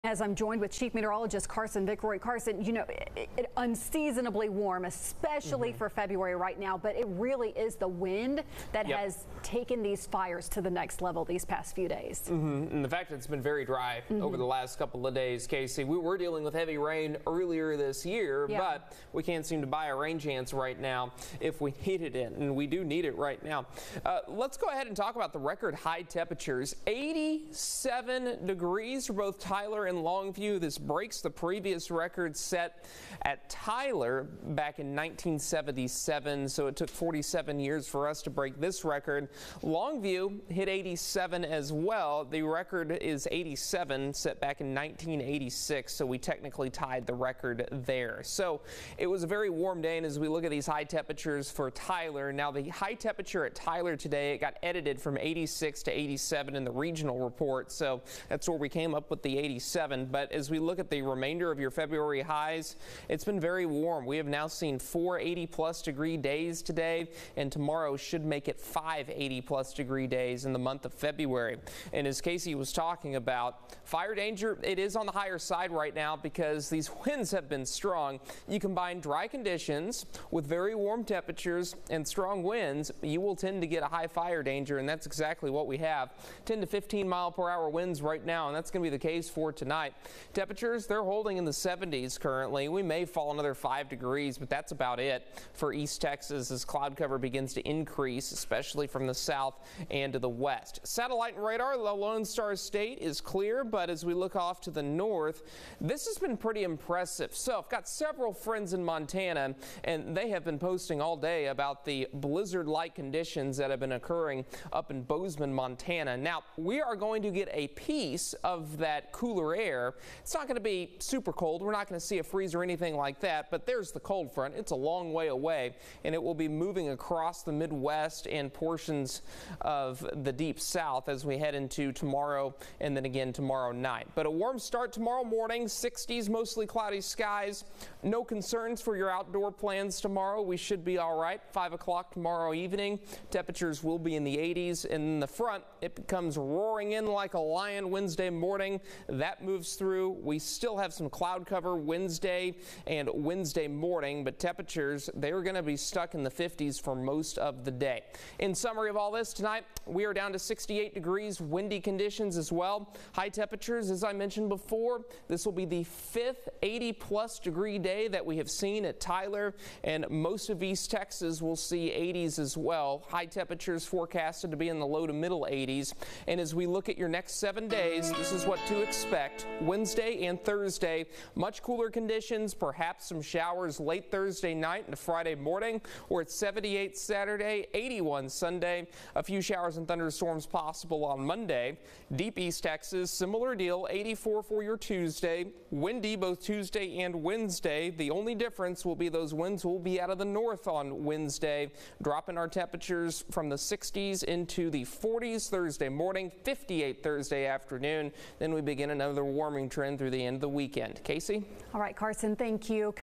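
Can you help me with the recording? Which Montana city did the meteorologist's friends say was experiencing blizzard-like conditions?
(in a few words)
Bozeman.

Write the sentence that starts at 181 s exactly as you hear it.
Much cooler conditions, perhaps some showers late Thursday night into Friday morning, or at 78 Saturday, 81 Sunday.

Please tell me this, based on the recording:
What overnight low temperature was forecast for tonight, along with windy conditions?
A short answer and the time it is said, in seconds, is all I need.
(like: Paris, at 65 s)
68 degrees, at 160 s.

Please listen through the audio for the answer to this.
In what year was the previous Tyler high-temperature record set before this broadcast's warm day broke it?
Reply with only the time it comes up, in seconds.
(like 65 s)
34 s.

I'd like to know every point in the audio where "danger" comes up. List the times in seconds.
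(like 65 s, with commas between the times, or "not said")
74 s, 84 s.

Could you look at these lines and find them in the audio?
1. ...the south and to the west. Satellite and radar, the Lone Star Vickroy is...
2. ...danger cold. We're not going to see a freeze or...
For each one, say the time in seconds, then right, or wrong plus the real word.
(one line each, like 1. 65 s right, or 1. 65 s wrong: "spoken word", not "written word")
1. 99 s wrong: "State", not "Vickroy"
2. 120 s wrong: "super", not "danger".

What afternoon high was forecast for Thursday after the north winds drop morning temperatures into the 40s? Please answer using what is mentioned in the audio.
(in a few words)
58.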